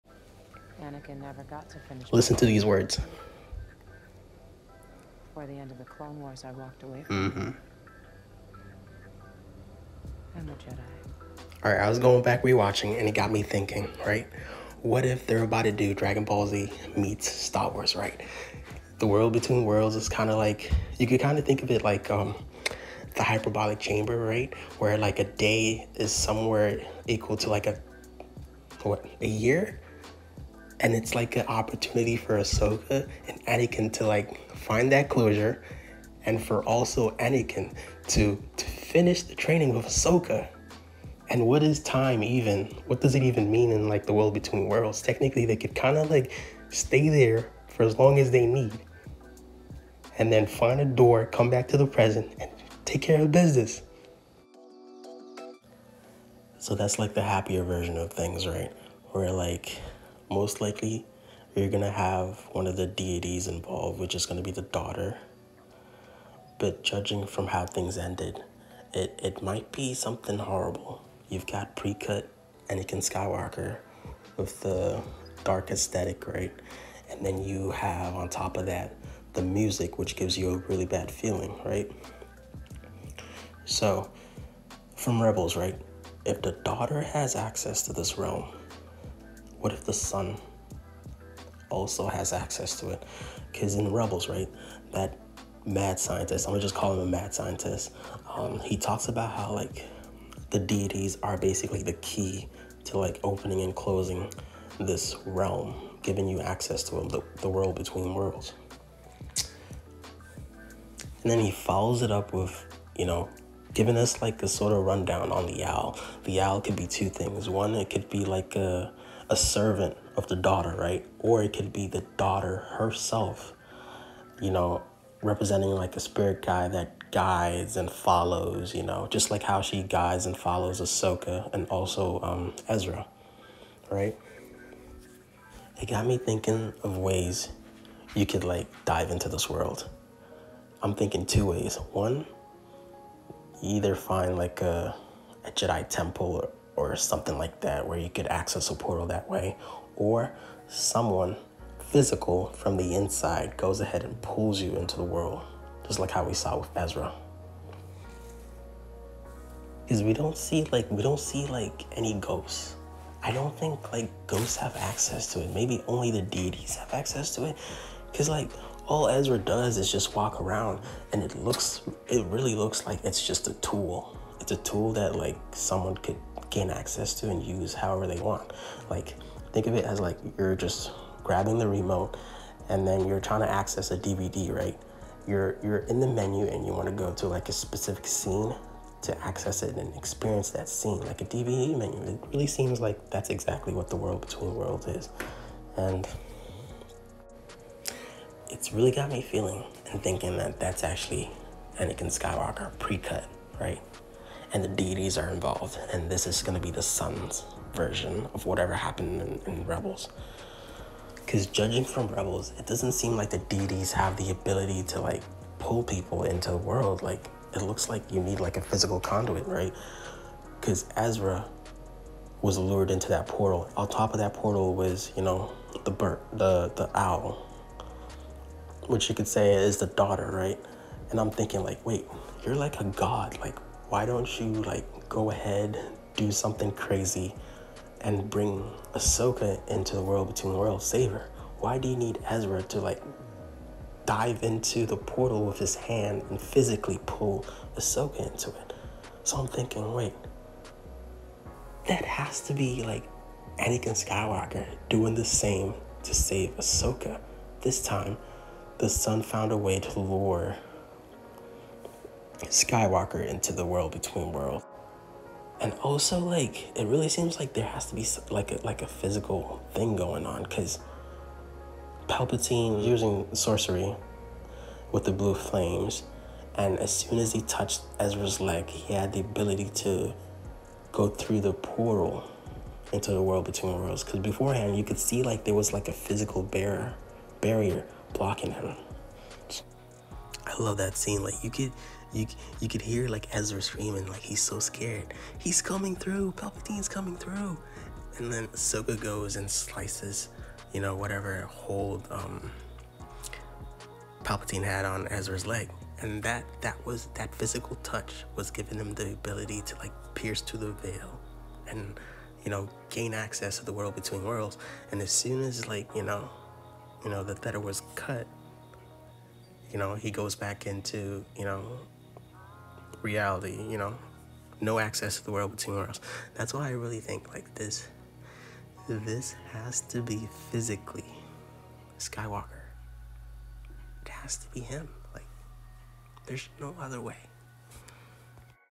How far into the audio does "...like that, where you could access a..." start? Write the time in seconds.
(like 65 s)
147 s.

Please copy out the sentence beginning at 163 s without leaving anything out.
I don't think like ghosts have access to it.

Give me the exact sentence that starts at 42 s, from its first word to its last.
What does it even mean in like the world between worlds?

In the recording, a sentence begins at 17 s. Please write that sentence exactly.
Right, the world between worlds is kind of like you could kind of think of it like um, the hyperbolic chamber, right?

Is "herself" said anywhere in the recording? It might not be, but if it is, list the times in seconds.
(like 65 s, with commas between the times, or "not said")
122 s.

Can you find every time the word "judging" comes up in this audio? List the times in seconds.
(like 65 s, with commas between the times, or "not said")
66 s, 211 s.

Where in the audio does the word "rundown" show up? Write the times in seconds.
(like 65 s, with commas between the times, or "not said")
114 s.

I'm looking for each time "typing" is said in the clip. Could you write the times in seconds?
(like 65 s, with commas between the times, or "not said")
not said.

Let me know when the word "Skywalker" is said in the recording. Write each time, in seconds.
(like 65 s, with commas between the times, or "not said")
72 s, 202 s, 254 s, 262 s, 331 s.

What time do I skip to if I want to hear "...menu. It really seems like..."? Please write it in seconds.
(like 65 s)
191 s.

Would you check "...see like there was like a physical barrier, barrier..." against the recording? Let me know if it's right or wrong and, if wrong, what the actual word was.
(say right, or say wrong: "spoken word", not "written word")
right.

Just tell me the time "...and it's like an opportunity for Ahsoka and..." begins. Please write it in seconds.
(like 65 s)
30 s.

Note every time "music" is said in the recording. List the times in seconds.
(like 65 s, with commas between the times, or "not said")
79 s.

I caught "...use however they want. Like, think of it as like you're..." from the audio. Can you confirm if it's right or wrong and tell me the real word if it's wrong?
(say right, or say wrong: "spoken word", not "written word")
right.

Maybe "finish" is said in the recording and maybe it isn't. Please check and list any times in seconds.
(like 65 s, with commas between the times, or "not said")
1 s, 38 s.